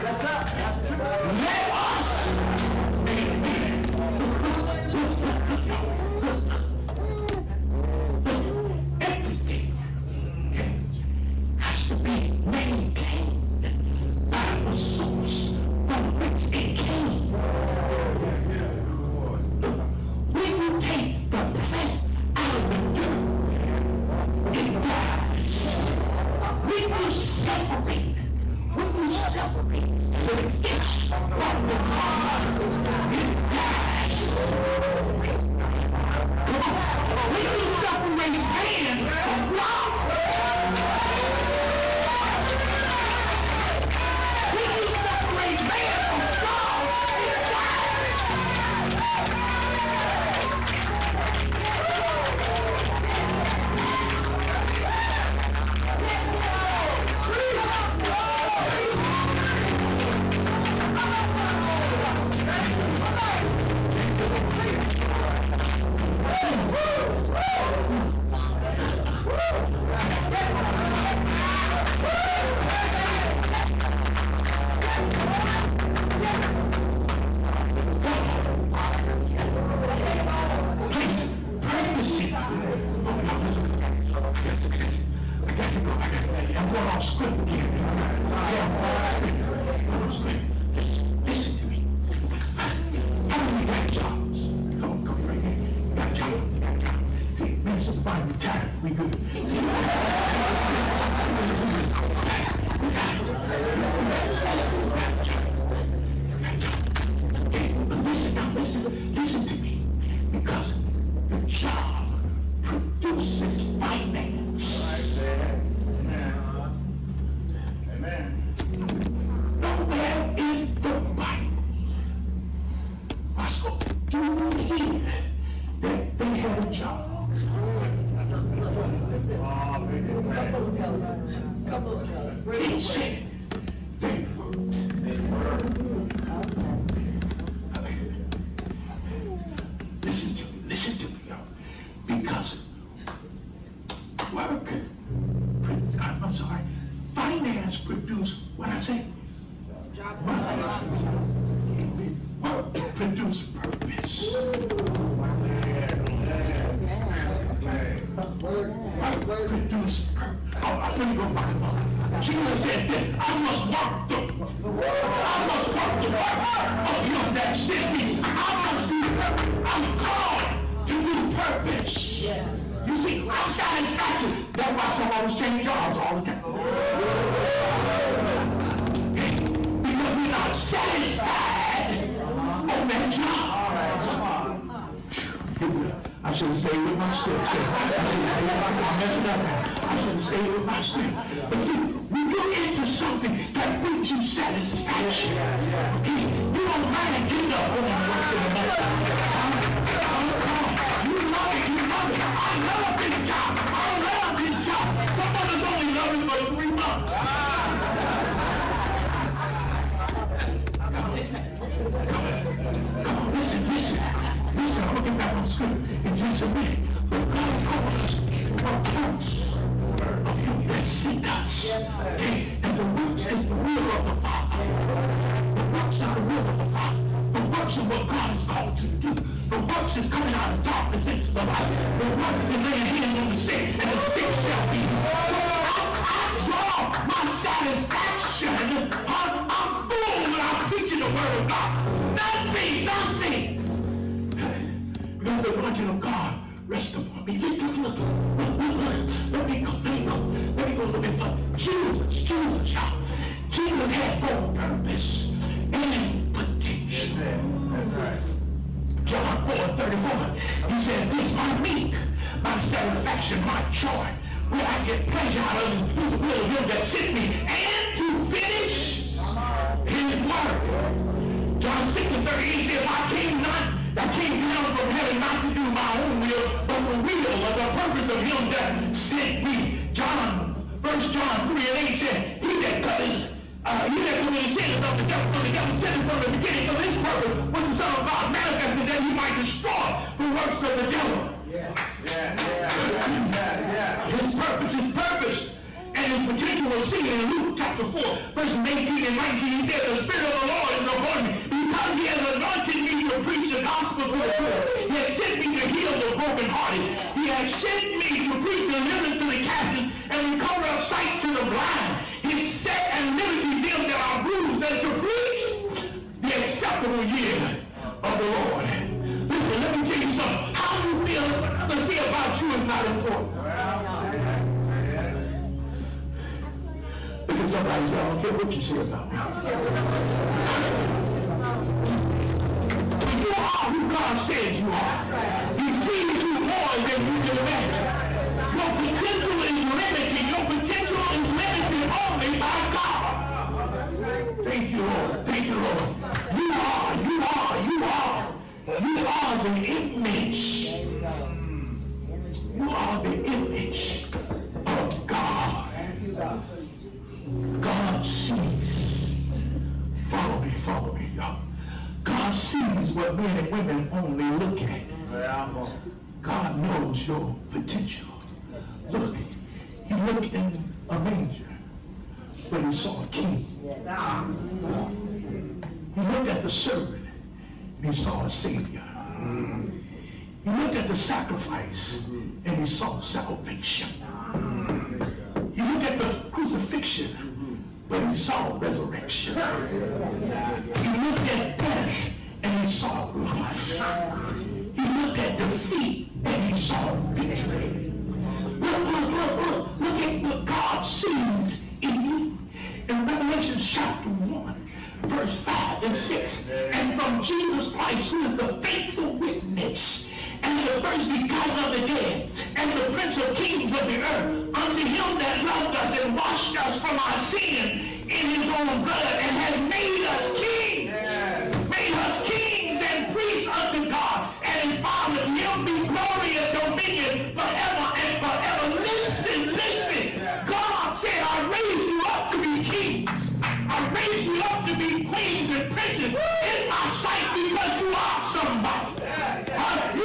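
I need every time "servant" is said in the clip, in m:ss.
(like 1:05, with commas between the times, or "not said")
6:16.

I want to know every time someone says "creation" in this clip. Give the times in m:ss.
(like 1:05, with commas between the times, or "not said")
not said.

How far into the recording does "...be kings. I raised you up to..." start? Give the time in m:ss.
7:12.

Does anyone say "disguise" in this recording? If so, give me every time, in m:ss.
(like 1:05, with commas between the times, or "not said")
not said.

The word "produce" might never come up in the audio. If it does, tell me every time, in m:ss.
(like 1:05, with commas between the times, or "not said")
2:32, 2:39.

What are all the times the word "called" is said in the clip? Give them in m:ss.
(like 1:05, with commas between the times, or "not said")
2:49, 3:37, 3:48.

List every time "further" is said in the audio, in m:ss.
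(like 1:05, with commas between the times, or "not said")
4:11.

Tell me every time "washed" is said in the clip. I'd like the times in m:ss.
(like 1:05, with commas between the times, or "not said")
6:56.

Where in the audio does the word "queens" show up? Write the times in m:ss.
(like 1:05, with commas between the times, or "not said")
7:15.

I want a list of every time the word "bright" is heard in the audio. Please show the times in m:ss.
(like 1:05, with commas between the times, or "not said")
not said.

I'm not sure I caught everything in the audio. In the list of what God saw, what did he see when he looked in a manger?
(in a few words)
A king.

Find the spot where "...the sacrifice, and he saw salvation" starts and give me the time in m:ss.
6:20.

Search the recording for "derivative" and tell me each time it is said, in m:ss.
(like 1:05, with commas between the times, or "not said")
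not said.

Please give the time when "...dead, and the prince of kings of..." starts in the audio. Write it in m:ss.
6:51.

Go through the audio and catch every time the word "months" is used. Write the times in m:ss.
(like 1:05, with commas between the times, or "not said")
3:26.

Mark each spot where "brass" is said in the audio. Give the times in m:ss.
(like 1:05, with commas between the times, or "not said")
not said.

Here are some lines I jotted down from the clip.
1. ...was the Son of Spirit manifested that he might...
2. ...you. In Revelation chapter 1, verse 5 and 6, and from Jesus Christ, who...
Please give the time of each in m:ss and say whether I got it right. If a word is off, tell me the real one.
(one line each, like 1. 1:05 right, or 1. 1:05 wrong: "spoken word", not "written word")
1. 4:47 wrong: "God", not "Spirit"
2. 6:42 right.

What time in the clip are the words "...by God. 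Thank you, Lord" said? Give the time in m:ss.
5:42.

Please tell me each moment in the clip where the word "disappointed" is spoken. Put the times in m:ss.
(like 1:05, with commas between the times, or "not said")
not said.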